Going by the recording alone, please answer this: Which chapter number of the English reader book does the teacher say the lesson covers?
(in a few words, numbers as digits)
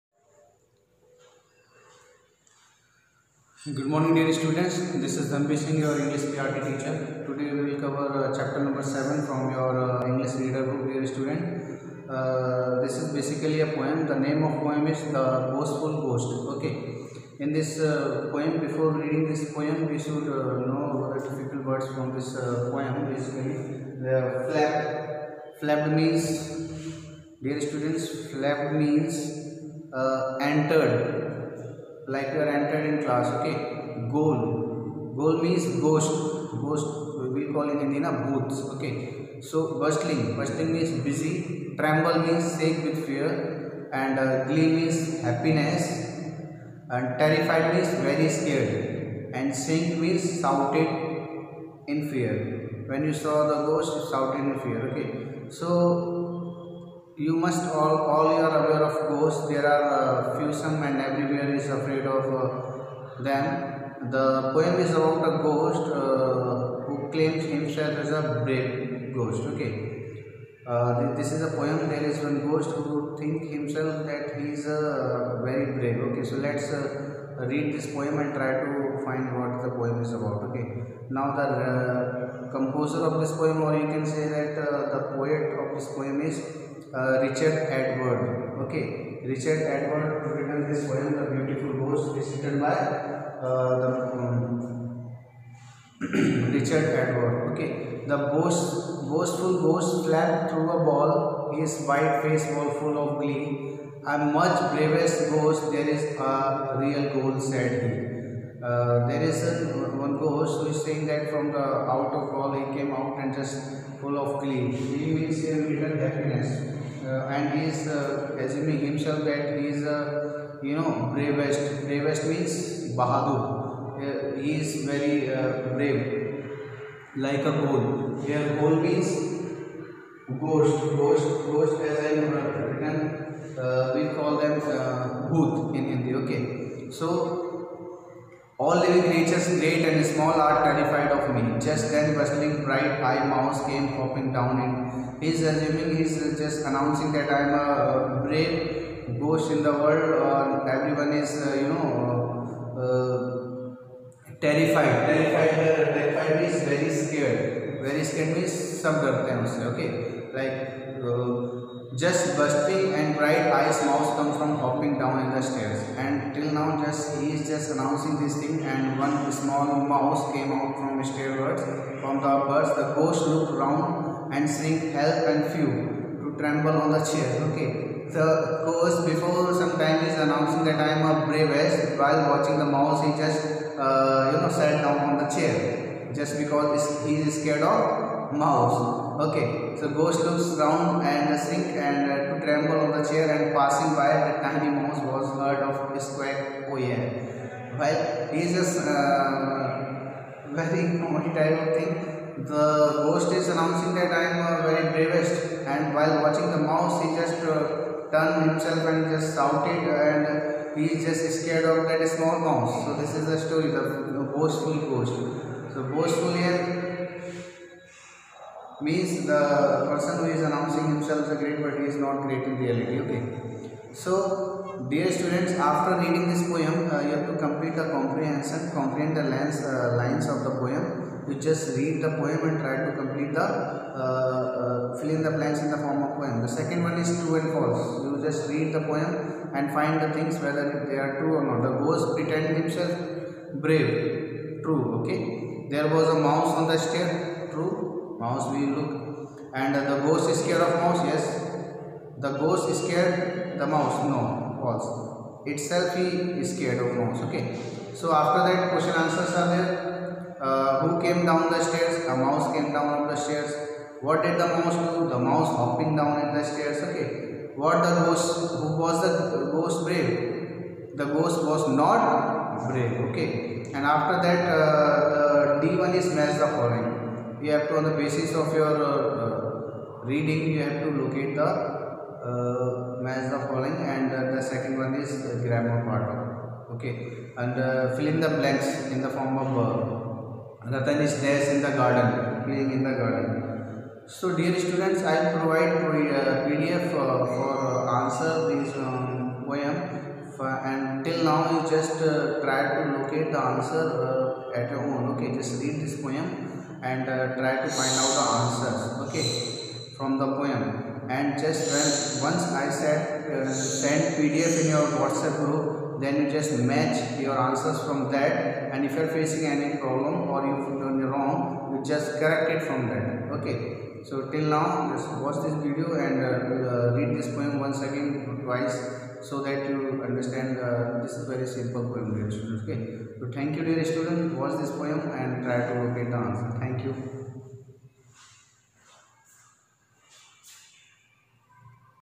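7.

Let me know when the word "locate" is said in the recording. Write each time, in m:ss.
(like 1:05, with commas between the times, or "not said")
4:41, 5:02, 5:35.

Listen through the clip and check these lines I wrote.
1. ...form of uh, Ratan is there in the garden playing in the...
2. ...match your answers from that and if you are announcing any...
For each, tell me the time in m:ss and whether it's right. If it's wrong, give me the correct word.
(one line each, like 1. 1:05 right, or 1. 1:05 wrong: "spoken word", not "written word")
1. 4:49 right
2. 5:16 wrong: "facing", not "announcing".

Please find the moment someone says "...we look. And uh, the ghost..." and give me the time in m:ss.
4:08.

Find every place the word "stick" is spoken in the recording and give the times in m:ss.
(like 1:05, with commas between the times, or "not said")
not said.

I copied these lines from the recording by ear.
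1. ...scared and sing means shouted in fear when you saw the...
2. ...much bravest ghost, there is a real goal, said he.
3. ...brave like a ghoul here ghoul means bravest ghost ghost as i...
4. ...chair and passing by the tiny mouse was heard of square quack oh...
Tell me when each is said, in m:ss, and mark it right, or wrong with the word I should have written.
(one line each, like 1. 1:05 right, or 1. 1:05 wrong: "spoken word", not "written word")
1. 0:48 right
2. 1:44 right
3. 2:05 wrong: "ghost", not "bravest"
4. 3:13 right.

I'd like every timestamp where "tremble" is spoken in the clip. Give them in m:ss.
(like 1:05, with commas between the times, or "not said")
0:41, 2:56, 3:12.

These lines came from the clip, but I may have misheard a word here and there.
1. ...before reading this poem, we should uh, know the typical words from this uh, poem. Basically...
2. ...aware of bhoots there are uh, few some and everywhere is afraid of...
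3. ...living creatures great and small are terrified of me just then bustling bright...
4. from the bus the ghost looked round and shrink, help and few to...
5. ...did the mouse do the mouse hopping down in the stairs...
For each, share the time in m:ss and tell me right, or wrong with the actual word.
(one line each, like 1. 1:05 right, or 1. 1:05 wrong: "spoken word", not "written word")
1. 0:18 right
2. 0:58 wrong: "ghosts", not "bhoots"
3. 2:18 right
4. 2:52 right
5. 4:24 right.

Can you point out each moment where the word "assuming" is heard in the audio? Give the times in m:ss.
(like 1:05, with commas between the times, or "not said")
1:58, 2:25.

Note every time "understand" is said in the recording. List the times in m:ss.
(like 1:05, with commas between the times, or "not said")
5:30.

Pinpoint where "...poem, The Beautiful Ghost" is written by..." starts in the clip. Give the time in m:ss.
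1:30.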